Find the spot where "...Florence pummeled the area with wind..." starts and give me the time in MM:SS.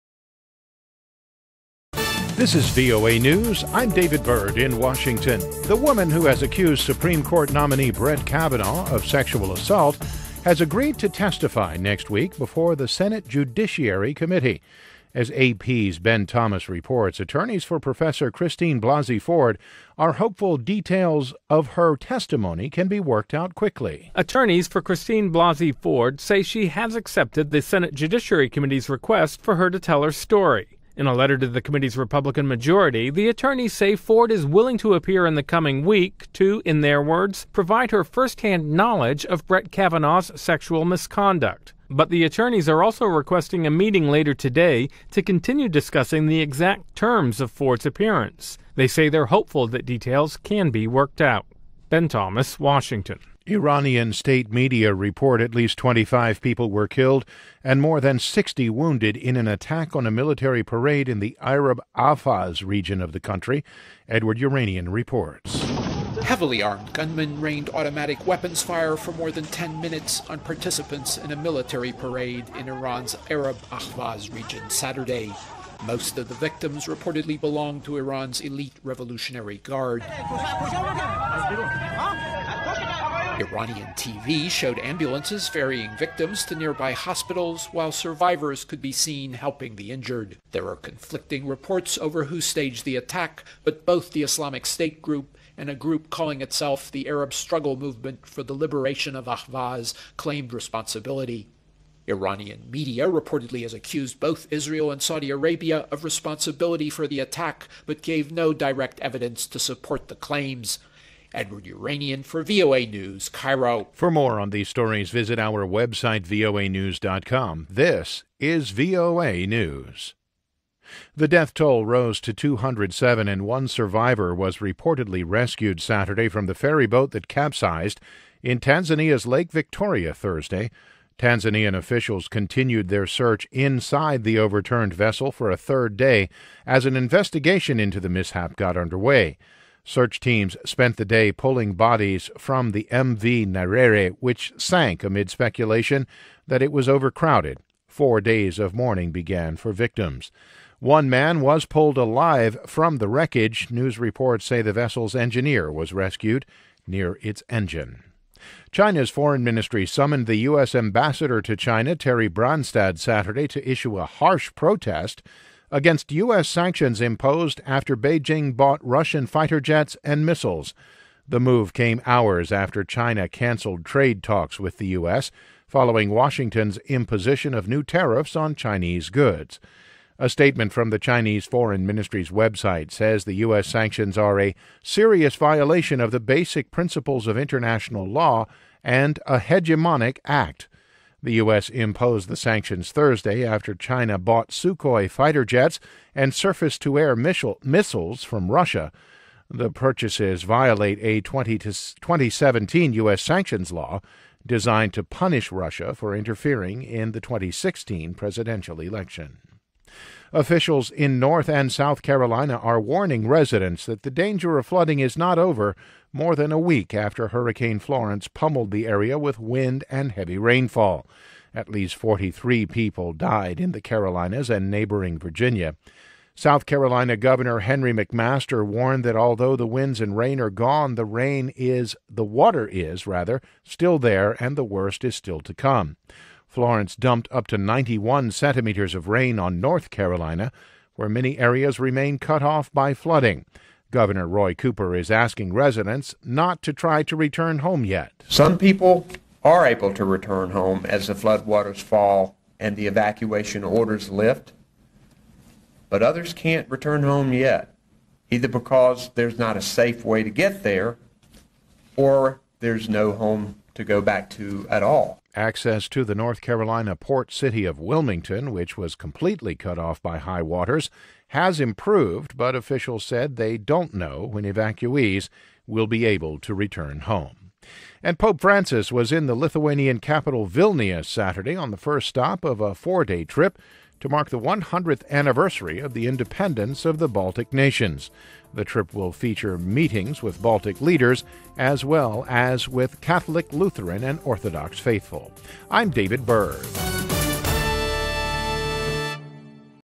03:37.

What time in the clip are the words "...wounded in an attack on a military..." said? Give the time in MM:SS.
00:58.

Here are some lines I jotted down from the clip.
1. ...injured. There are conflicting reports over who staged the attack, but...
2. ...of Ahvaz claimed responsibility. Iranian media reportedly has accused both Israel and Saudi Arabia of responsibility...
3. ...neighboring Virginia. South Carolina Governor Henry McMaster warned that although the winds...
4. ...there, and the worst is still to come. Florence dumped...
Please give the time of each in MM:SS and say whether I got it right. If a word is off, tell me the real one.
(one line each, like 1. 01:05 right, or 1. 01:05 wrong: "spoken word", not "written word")
1. 01:29 right
2. 01:39 right
3. 03:44 right
4. 03:53 right.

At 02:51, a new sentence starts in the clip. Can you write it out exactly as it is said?
The move came hours after China canceled trade talks with the U.S.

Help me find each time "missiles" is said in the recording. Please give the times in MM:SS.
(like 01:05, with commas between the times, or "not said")
02:50, 03:17.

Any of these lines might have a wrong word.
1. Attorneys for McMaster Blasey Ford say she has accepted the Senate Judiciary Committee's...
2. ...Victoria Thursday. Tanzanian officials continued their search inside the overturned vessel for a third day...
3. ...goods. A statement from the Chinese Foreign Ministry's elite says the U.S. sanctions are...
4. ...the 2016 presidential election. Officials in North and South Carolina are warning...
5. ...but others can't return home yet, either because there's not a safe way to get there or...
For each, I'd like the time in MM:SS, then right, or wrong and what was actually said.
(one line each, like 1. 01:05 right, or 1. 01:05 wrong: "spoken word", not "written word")
1. 00:24 wrong: "Christine", not "McMaster"
2. 02:09 right
3. 02:59 wrong: "website", not "elite"
4. 03:27 right
5. 04:15 right.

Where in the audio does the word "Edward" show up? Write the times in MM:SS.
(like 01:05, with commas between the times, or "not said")
01:04, 01:51.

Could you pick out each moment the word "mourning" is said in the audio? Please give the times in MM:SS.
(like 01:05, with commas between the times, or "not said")
02:28.